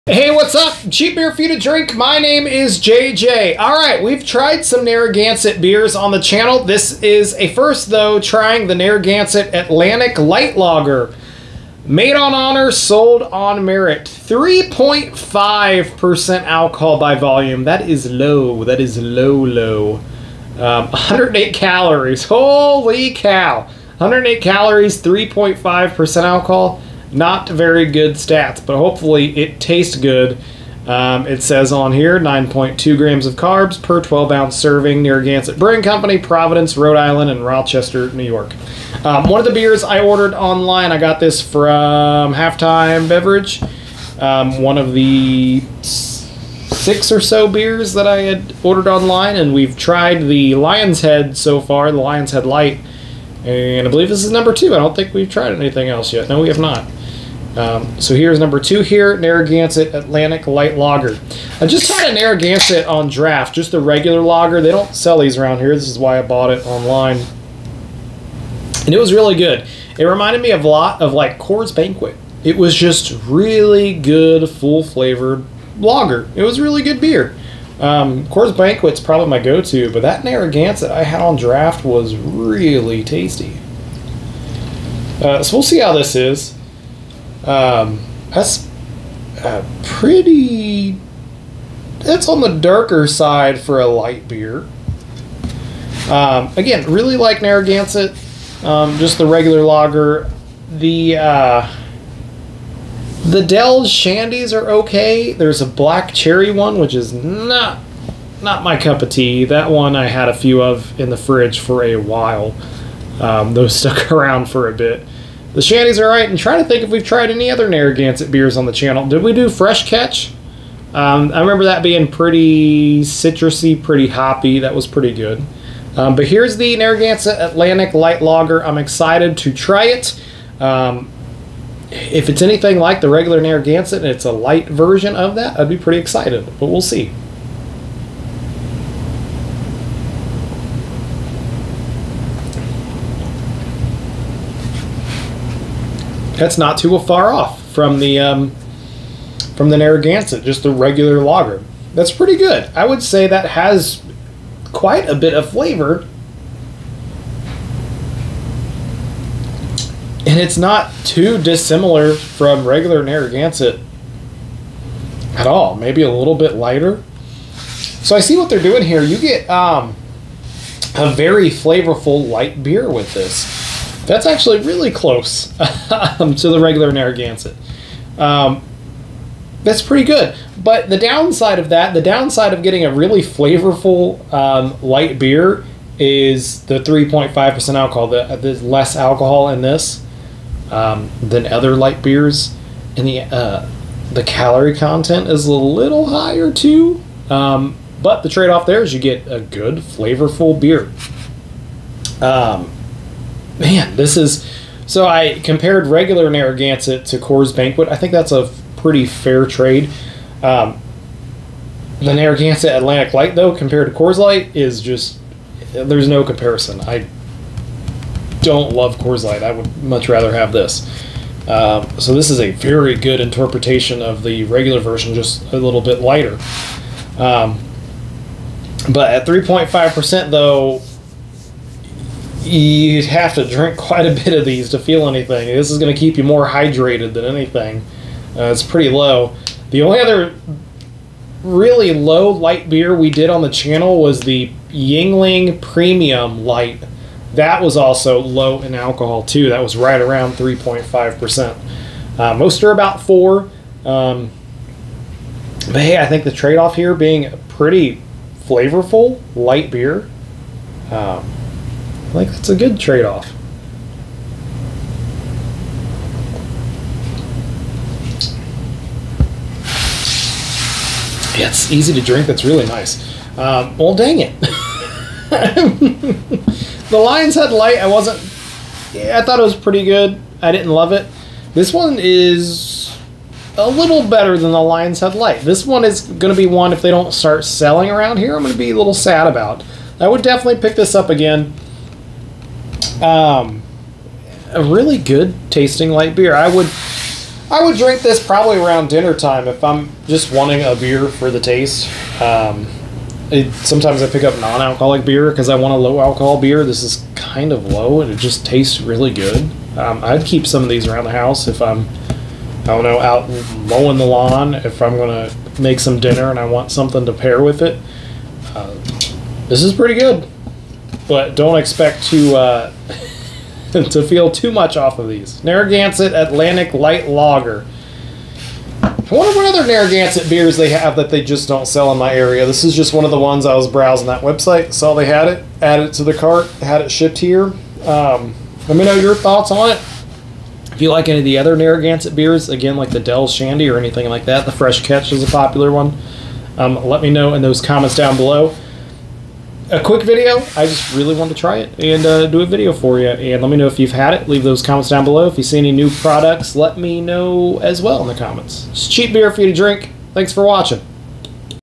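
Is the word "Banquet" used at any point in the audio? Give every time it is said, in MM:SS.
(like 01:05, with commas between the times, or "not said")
01:11, 01:18, 03:27.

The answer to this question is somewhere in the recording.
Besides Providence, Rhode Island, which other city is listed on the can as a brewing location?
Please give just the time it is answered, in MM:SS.
00:37.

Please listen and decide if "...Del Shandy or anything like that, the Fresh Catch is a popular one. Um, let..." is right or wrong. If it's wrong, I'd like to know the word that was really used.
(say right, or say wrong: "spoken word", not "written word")
right.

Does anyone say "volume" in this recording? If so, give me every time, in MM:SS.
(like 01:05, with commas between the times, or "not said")
00:17.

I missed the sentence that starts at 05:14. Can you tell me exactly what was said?
If I'm gonna make some dinner and I want something to pair with it, uh, this is pretty good.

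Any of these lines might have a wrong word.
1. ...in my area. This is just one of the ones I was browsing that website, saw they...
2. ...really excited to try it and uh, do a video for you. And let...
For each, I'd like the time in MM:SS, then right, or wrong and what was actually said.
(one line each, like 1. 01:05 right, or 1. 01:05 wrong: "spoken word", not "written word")
1. 05:31 right
2. 05:50 wrong: "wanted", not "excited".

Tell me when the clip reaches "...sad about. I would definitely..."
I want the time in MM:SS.
04:48.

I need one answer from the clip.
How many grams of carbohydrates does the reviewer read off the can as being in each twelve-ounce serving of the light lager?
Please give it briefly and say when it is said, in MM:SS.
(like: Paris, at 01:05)
9.2, at 00:32.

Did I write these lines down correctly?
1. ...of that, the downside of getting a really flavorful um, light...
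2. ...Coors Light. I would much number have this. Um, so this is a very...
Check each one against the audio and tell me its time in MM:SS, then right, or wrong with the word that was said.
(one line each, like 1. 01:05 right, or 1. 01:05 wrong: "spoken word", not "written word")
1. 03:01 right
2. 03:38 wrong: "rather", not "number".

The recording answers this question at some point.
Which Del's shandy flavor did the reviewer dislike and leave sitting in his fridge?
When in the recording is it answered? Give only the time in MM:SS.
01:45.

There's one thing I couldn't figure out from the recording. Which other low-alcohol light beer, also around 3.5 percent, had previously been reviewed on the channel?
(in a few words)
Yuengling Premium Light.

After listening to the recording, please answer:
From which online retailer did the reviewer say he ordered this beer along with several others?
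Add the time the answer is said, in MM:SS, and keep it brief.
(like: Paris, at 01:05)
Halftime Beverage, at 00:42.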